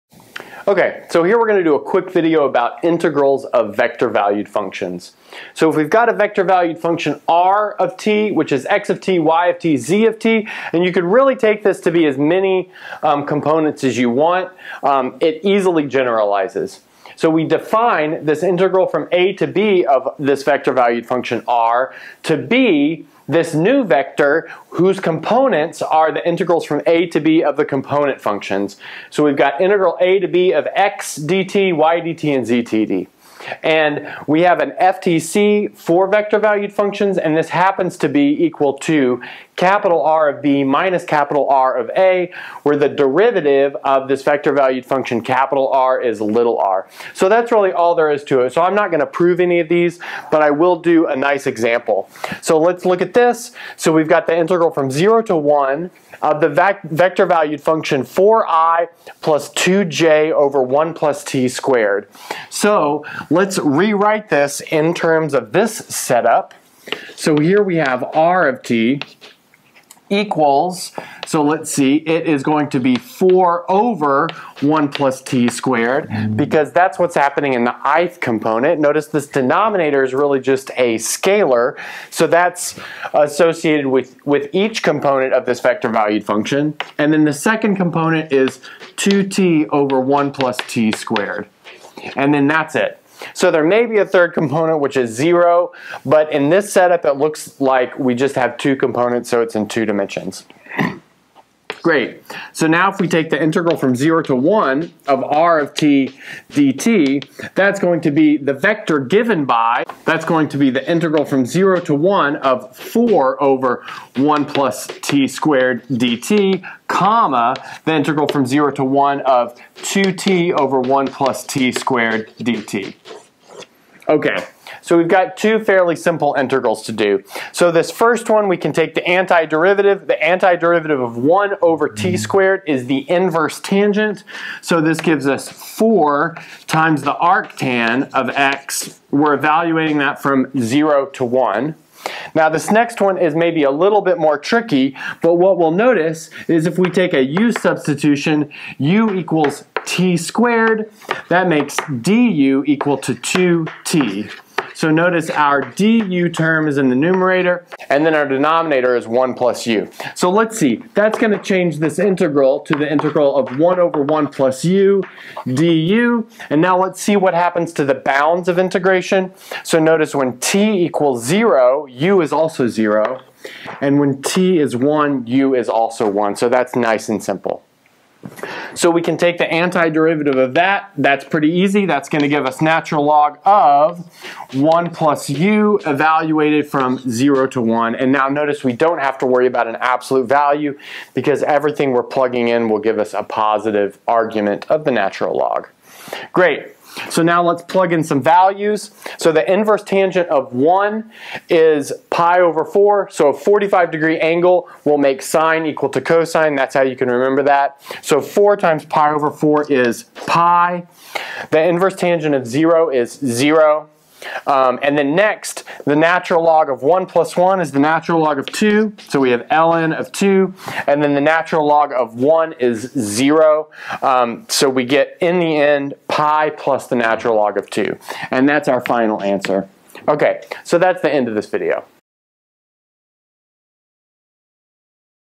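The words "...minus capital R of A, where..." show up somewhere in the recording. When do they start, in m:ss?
0:40.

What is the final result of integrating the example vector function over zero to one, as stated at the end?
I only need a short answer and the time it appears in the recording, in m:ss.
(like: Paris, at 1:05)
pi plus ln 2, at 3:46.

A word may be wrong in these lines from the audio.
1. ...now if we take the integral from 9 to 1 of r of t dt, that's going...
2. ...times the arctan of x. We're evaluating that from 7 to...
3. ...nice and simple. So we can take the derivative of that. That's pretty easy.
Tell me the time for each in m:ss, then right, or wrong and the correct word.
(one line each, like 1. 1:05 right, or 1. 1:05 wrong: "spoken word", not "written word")
1. 1:42 wrong: "0", not "9"
2. 2:16 wrong: "0", not "7"
3. 2:56 wrong: "antiderivative", not "derivative".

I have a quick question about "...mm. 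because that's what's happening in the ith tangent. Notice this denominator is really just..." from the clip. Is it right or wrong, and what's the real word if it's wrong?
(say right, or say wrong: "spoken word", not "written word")
wrong: "component", not "tangent".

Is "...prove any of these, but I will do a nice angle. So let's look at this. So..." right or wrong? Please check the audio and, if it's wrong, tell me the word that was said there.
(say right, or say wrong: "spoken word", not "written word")
wrong: "example", not "angle".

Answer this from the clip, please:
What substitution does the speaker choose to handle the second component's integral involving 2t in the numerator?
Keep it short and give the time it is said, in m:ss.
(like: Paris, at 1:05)
u equals t squared, at 2:28.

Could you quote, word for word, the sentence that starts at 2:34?
So notice our du term is in the numerator, and then our denominator is 1 plus u.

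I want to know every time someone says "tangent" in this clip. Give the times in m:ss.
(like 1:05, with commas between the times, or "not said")
2:13, 3:19, 3:31.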